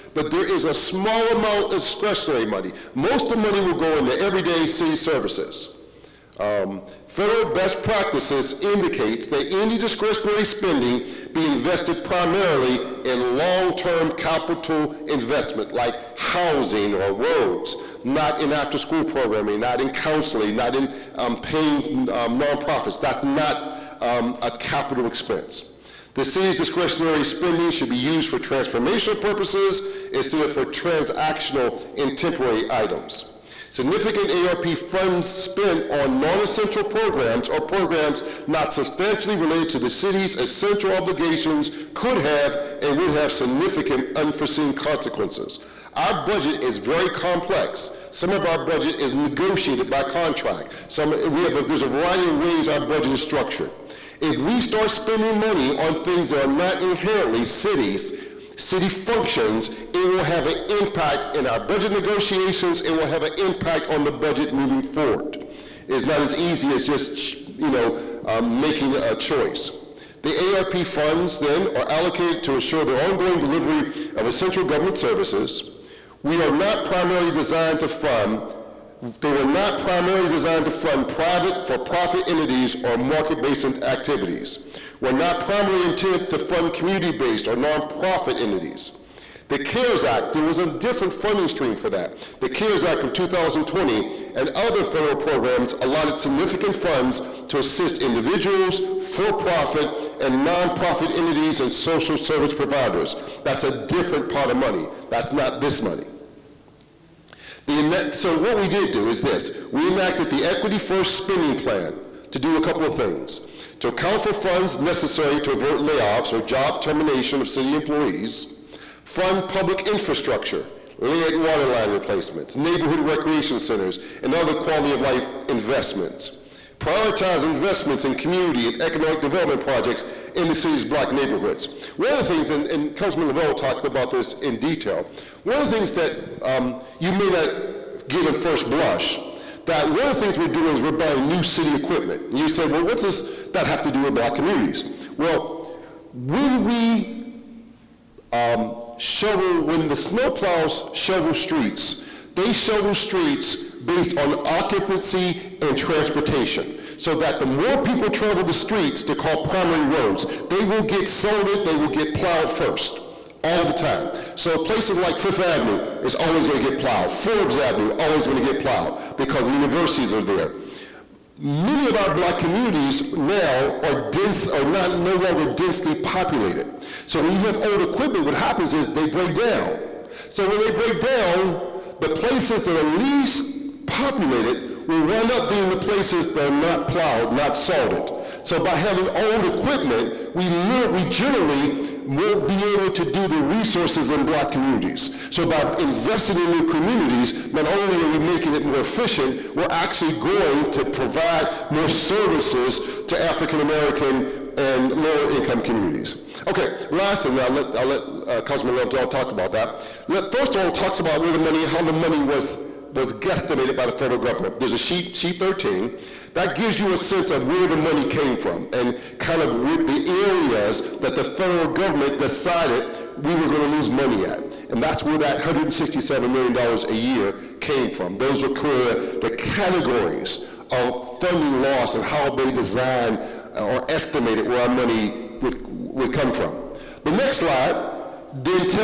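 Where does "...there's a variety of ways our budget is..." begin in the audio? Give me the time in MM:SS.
00:51.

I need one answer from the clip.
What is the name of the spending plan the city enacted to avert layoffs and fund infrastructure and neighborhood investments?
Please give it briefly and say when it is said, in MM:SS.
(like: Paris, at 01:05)
Equity First Spending Plan, at 01:50.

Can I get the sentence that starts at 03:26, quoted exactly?
Okay, last thing, I'll let, I'll let uh, Councilman Lovejoy talk about that.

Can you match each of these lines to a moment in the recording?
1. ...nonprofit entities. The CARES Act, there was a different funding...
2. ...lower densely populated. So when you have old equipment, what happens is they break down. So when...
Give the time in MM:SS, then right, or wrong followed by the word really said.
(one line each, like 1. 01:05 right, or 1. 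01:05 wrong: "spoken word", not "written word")
1. 01:27 right
2. 02:55 wrong: "longer", not "lower".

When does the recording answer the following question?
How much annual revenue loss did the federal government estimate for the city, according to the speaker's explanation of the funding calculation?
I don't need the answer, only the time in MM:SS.
03:45.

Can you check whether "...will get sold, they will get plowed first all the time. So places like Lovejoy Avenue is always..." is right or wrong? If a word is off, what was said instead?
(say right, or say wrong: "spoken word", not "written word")
wrong: "Fifth", not "Lovejoy".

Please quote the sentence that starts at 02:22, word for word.
And you say, well, what does that have to do with black communities?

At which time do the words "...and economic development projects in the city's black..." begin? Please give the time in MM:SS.
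02:08.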